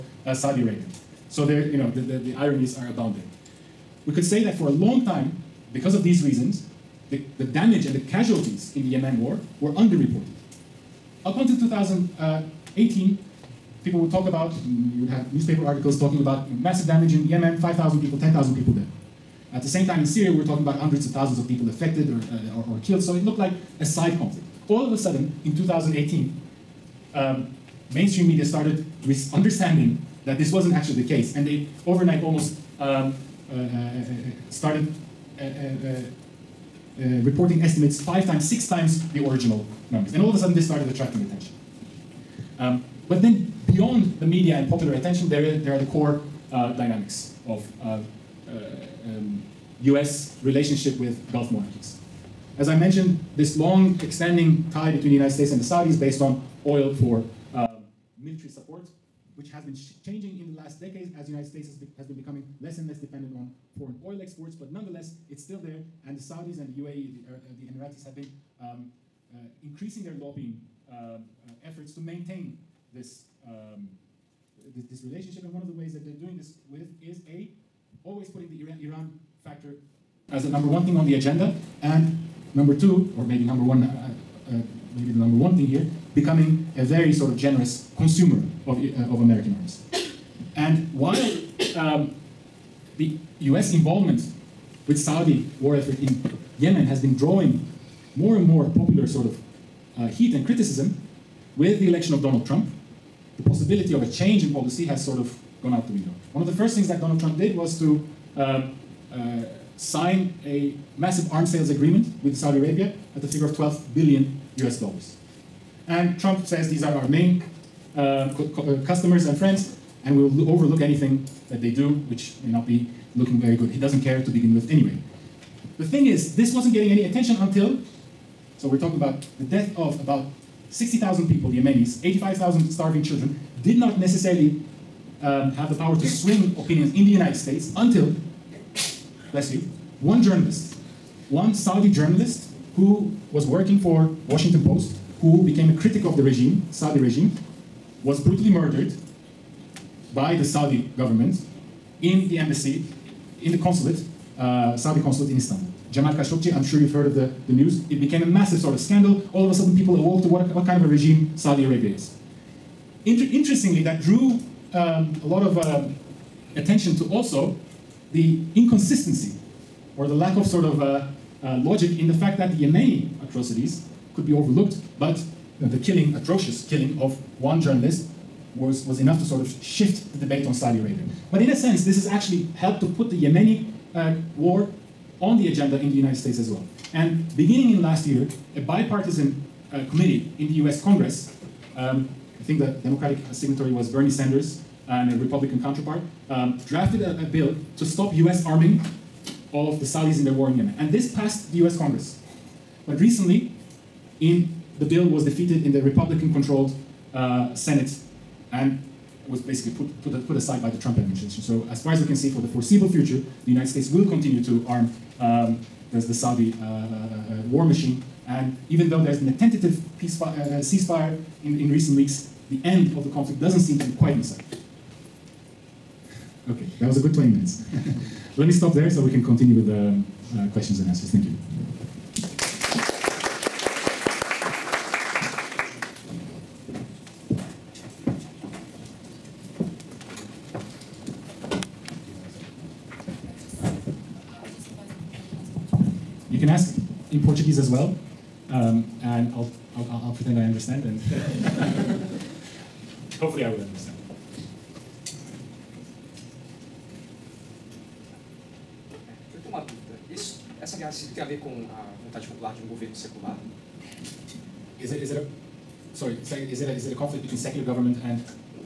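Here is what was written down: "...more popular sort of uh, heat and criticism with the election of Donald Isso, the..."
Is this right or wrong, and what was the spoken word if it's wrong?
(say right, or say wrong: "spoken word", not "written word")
wrong: "Trump", not "Isso".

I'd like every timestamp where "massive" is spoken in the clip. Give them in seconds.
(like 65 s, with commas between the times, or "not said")
16 s, 110 s, 158 s.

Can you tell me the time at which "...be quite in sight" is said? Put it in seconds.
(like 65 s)
223 s.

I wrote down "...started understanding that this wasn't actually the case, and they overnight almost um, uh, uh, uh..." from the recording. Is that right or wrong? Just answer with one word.
right.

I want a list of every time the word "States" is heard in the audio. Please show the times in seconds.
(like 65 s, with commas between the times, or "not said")
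55 s, 61 s, 137 s, 186 s, 213 s.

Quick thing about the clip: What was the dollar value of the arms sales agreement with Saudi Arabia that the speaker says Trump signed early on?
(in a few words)
12 billion US dollars.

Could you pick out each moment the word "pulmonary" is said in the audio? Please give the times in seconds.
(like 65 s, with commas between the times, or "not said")
not said.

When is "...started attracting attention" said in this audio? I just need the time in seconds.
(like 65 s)
40 s.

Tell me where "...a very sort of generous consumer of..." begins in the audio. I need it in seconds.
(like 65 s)
86 s.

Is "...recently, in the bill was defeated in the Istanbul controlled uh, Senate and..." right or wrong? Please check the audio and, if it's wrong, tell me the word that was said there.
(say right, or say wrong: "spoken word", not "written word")
wrong: "Republican", not "Istanbul".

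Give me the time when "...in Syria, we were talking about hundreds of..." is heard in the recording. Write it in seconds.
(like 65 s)
19 s.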